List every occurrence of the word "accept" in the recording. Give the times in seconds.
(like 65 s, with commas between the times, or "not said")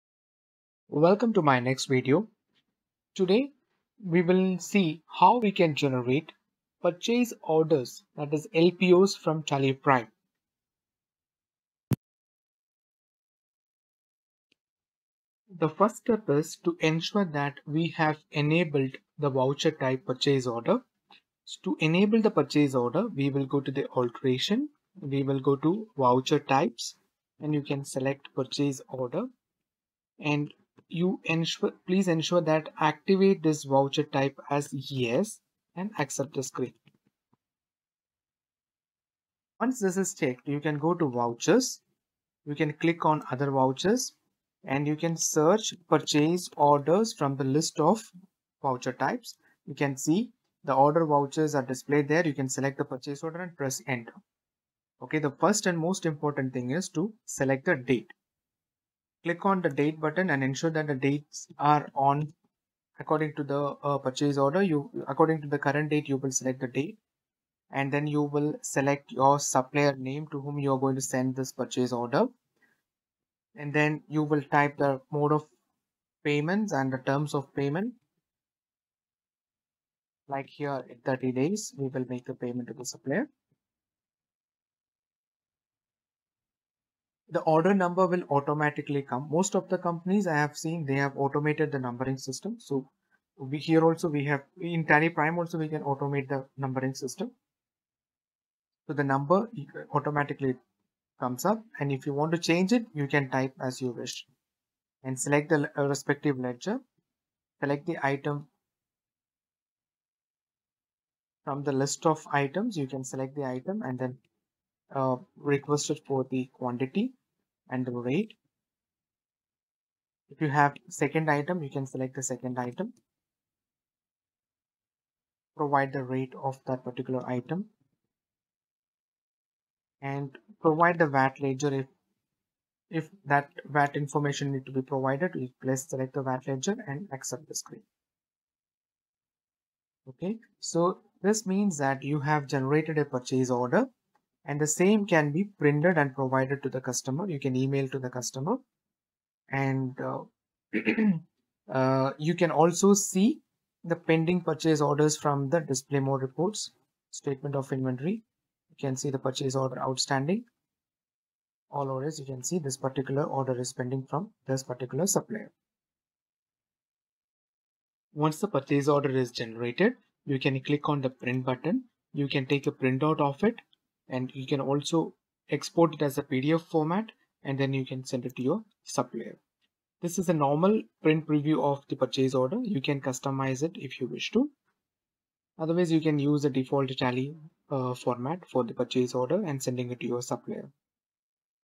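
35 s, 137 s.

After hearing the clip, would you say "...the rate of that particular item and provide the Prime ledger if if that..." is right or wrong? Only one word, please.
wrong.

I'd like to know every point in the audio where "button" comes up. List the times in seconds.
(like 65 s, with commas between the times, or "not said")
59 s, 171 s.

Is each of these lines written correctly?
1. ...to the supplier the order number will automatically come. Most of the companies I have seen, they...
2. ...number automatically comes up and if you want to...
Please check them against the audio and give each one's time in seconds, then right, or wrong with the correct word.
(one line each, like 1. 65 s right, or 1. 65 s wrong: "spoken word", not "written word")
1. 82 s right
2. 99 s right.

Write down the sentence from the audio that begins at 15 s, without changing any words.
The first step is to ensure that we have enabled the voucher type purchase order.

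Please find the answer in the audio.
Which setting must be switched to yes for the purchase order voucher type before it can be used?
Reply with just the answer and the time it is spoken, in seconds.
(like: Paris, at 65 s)
Activate this voucher type, at 32 s.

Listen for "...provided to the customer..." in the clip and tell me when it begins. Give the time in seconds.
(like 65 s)
146 s.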